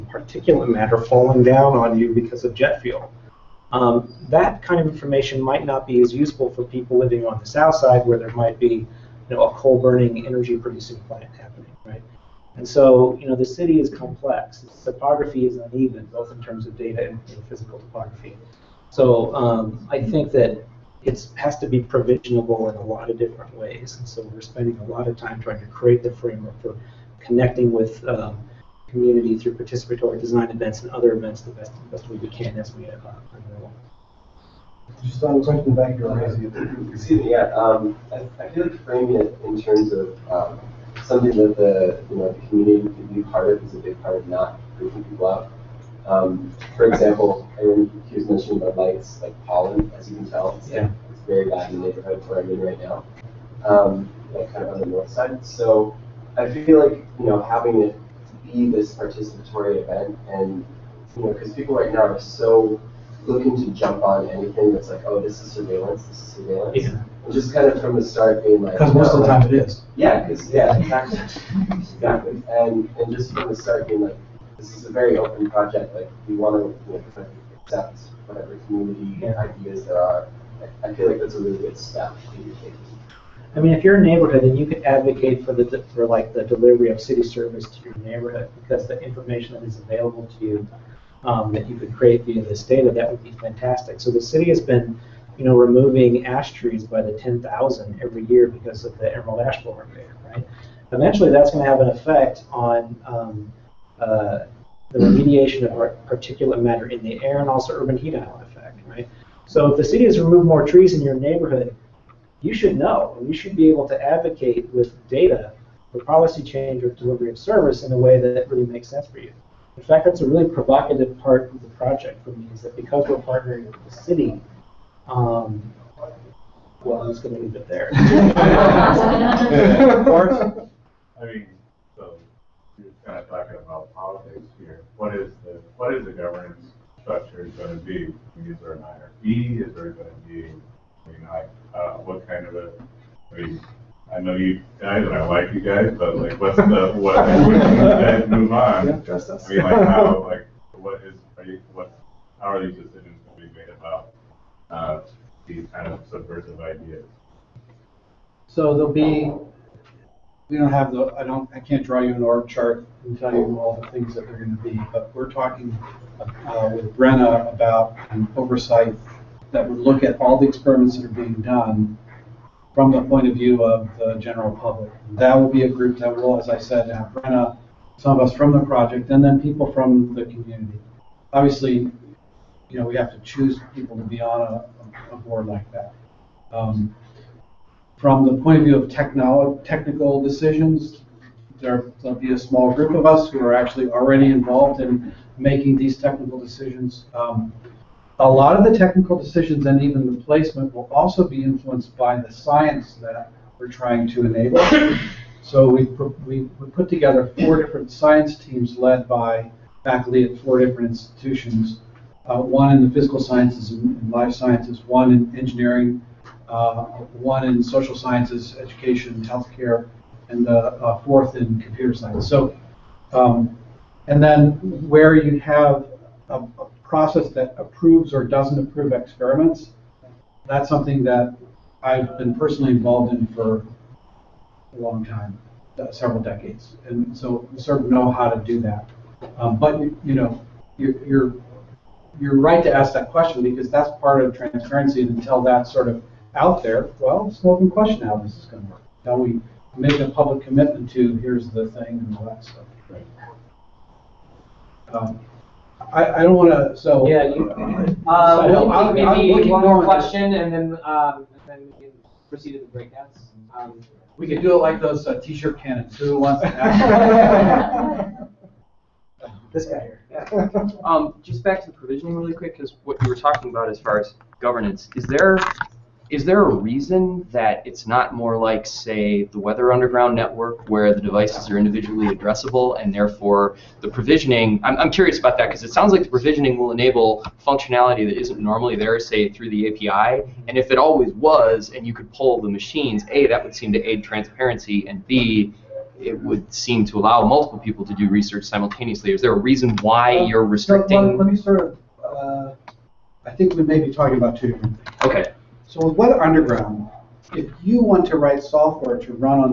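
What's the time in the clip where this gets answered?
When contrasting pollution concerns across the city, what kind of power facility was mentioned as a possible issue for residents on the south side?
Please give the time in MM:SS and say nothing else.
00:09.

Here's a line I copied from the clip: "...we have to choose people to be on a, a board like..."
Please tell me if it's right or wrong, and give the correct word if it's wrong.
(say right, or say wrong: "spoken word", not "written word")
right.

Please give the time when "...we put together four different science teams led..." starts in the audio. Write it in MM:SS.
03:26.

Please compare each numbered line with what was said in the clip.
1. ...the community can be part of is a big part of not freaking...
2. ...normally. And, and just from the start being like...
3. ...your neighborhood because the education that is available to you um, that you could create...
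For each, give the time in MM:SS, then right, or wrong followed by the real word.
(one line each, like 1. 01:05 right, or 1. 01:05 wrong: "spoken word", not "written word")
1. 00:42 right
2. 01:11 wrong: "exactly", not "normally"
3. 01:27 wrong: "information", not "education".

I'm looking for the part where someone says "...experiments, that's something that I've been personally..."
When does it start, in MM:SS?
03:48.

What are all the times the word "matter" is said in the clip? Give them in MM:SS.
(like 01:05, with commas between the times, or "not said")
00:00, 01:46.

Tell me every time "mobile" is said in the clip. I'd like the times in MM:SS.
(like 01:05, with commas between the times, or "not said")
not said.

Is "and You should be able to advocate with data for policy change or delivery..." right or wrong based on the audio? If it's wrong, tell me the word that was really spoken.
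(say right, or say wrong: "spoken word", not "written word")
right.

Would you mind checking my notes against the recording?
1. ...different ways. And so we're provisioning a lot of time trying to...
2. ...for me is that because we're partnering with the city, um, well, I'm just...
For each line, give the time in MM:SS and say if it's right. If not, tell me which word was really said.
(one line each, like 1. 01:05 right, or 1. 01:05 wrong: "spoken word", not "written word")
1. 00:23 wrong: "spending", not "provisioning"
2. 02:02 right.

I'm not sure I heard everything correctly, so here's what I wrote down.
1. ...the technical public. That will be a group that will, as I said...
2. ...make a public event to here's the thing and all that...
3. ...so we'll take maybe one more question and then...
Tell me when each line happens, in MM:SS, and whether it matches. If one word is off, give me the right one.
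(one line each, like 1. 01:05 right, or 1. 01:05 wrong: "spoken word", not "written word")
1. 02:53 wrong: "general", not "technical"
2. 04:09 wrong: "commitment", not "event"
3. 04:18 right.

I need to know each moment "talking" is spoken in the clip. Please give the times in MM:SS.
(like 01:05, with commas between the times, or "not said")
02:13, 02:45, 04:33, 05:03.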